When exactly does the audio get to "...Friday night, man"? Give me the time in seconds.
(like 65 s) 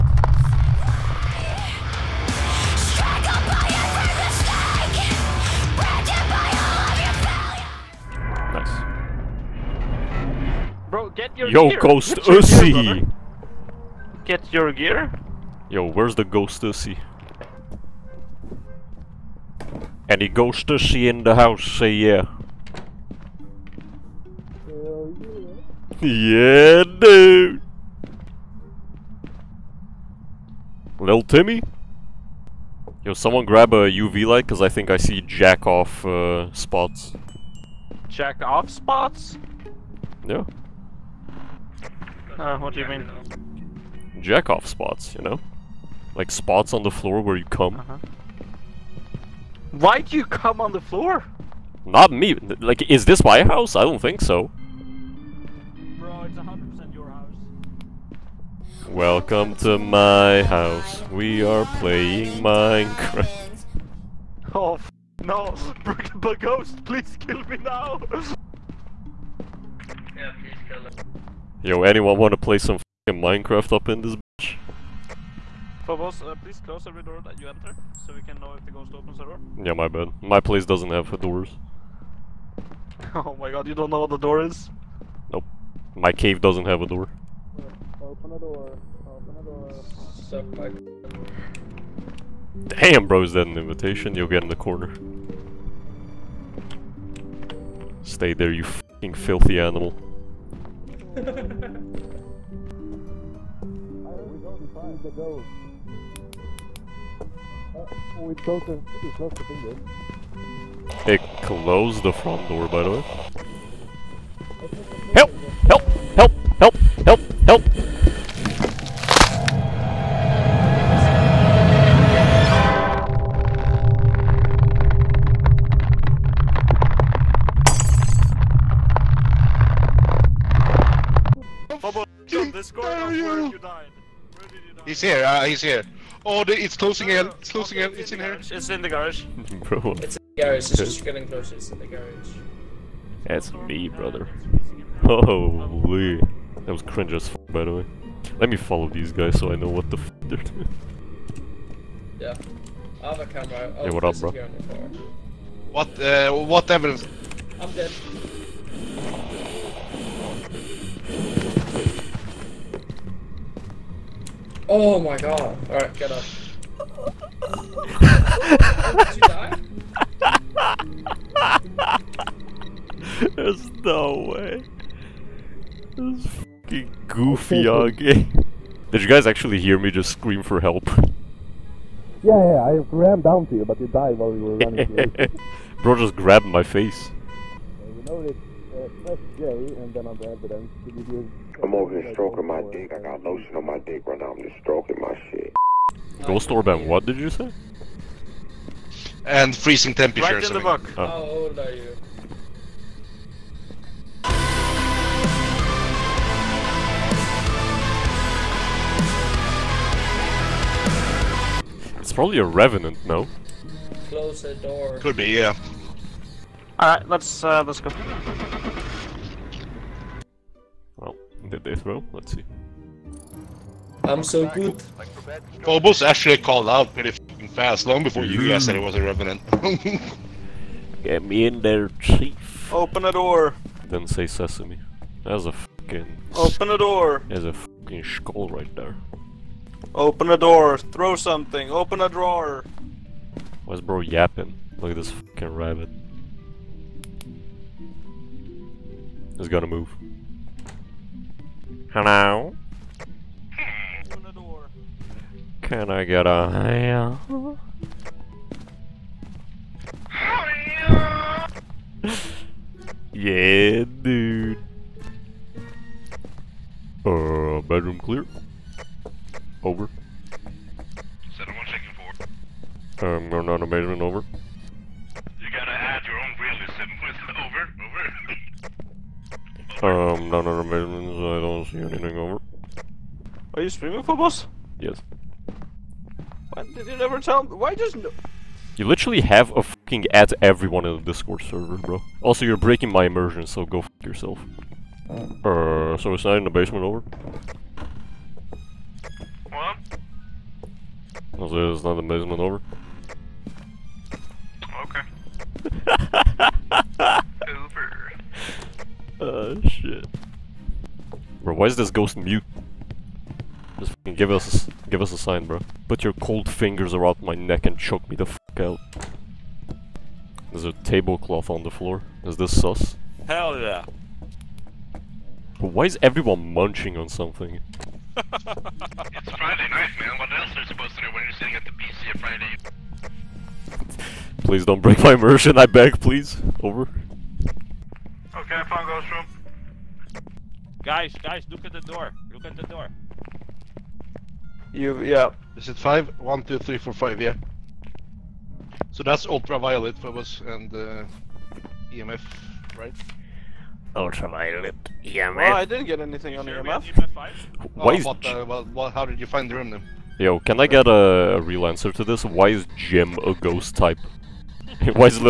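328 s.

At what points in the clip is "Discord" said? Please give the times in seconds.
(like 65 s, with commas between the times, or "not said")
291 s.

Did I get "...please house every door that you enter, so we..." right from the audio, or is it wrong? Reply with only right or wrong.
wrong.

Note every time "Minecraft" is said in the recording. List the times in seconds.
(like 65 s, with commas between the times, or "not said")
62 s, 73 s.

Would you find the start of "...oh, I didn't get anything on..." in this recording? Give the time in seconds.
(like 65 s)
355 s.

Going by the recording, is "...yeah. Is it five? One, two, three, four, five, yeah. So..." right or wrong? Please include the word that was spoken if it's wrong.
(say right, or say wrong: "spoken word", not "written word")
right.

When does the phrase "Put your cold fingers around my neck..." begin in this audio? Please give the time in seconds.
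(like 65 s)
315 s.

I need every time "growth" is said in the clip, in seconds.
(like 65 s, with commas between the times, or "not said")
not said.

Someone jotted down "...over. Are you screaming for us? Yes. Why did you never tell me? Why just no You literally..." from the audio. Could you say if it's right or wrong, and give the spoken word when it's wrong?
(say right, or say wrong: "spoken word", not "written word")
right.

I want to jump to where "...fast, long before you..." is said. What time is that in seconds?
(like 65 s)
227 s.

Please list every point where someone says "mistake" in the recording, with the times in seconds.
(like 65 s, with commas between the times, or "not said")
not said.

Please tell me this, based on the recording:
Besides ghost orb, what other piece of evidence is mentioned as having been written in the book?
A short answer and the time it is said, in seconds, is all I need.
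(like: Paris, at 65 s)
Freezing temperatures, at 199 s.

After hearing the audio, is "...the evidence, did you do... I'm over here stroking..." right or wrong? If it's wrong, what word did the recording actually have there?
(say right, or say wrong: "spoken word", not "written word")
right.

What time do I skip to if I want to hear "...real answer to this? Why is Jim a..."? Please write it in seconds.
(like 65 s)
361 s.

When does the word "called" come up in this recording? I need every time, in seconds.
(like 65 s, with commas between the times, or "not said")
226 s.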